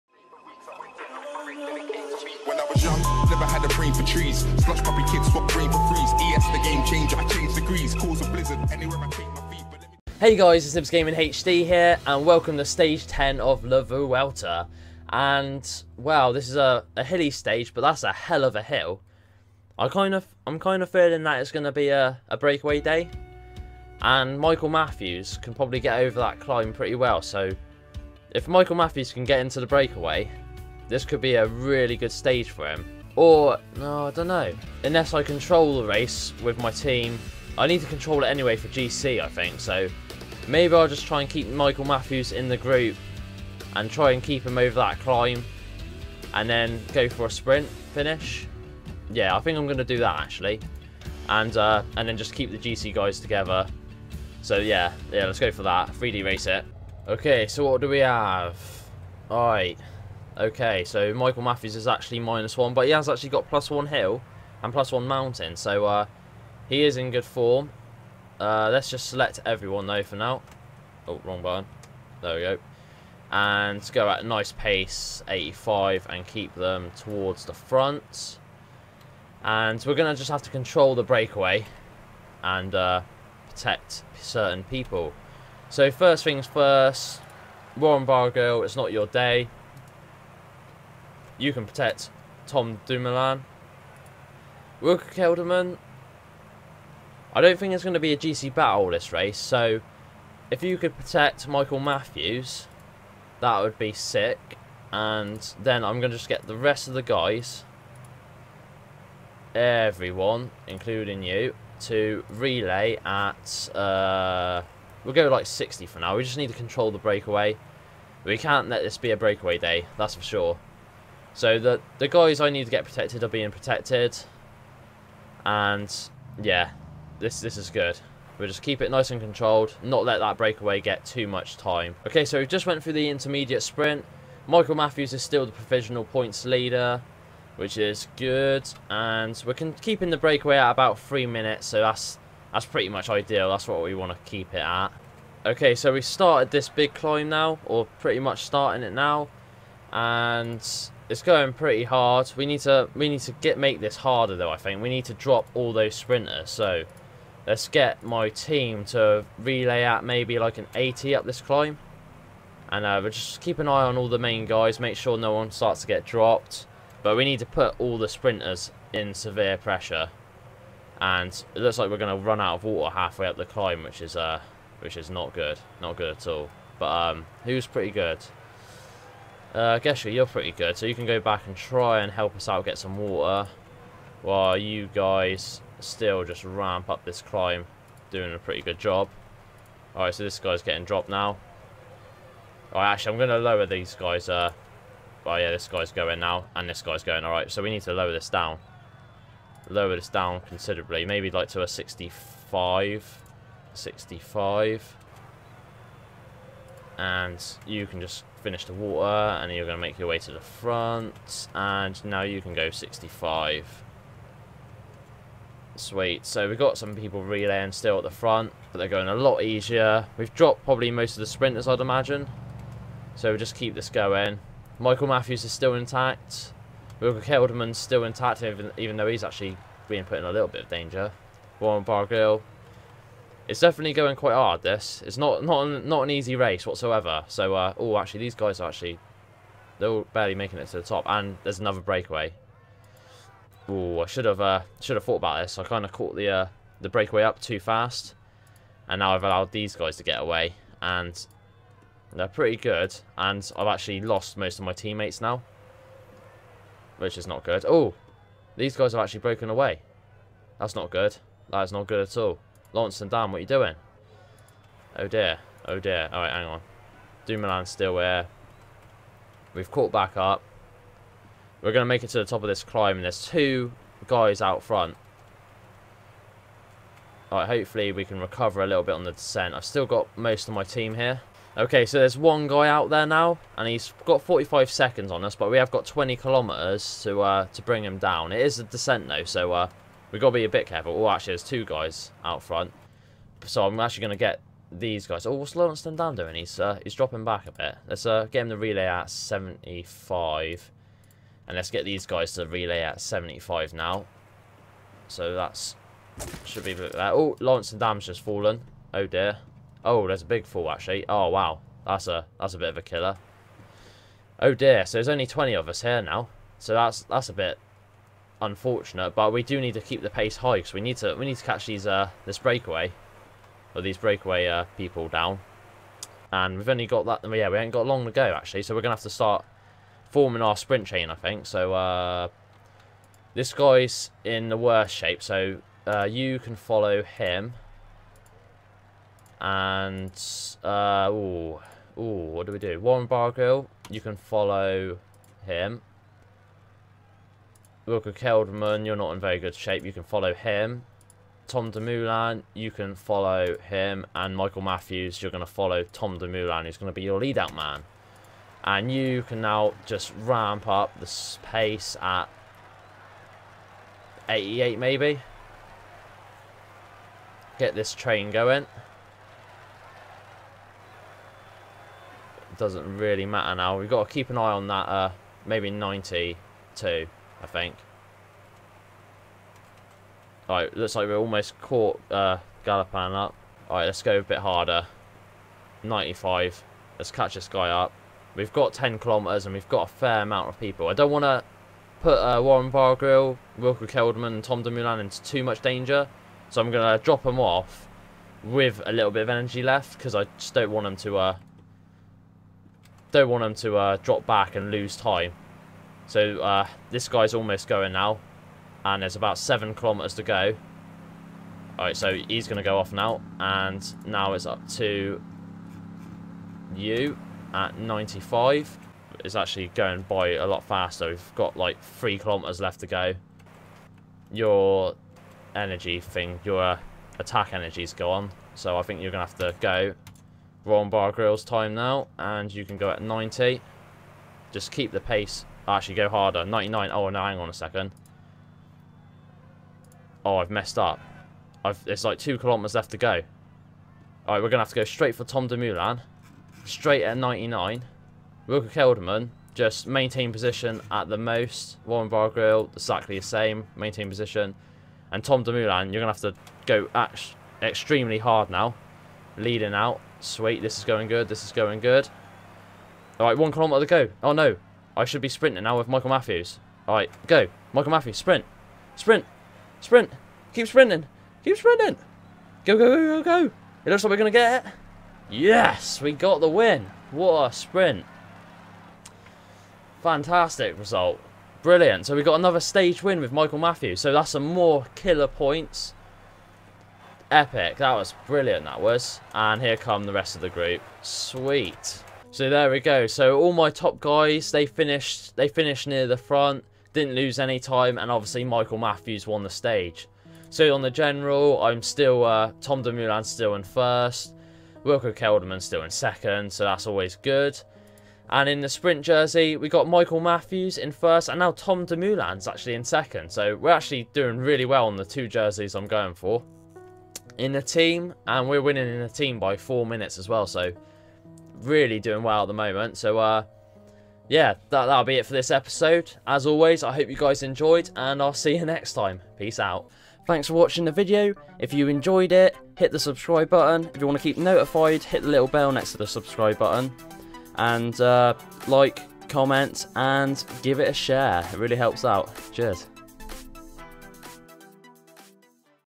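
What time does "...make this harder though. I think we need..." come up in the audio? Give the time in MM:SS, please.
02:33.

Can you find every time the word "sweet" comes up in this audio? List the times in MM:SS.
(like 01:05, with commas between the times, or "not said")
03:35, 07:40, 08:11.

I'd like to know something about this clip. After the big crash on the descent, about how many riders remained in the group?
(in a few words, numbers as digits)
20.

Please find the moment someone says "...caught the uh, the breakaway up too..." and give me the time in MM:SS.
04:05.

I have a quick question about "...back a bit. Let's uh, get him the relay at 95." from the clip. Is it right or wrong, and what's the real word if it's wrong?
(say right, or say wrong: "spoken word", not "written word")
wrong: "75", not "95".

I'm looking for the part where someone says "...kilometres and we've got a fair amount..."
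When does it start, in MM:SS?
06:28.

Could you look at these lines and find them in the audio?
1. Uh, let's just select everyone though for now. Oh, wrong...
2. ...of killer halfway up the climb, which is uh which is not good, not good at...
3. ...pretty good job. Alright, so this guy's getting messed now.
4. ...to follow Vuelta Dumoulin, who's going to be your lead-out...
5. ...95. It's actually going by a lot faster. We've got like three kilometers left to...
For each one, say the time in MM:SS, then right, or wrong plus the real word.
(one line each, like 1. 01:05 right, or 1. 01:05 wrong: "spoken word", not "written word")
1. 01:08 right
2. 02:52 wrong: "water", not "killer"
3. 03:08 wrong: "dropped", not "messed"
4. 05:55 wrong: "Tom", not "Vuelta"
5. 06:57 right.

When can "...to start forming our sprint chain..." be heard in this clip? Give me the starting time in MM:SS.
05:29.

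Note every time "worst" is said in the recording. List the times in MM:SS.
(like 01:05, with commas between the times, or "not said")
05:34.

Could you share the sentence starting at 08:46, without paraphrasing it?
As always, I hope you guys enjoyed, and I'll see you next time.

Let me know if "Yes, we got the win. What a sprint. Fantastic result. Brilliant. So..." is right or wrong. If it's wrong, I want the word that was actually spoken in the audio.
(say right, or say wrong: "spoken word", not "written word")
right.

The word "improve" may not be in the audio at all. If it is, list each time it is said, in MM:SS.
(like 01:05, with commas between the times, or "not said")
not said.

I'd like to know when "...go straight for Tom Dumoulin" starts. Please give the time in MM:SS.
07:24.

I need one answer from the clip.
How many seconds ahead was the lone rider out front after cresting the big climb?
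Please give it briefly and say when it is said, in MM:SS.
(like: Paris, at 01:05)
45, at 04:44.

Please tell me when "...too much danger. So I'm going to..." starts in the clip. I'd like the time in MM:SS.
06:35.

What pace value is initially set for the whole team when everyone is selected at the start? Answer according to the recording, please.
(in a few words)
85.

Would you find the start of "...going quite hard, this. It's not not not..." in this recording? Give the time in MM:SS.
03:53.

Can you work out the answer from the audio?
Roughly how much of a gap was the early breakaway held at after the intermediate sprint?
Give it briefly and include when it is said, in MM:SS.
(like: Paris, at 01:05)
three minutes, at 02:20.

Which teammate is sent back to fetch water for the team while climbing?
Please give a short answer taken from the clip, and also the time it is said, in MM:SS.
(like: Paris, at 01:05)
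Geschke, at 02:59.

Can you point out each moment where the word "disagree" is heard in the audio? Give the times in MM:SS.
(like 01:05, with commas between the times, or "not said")
not said.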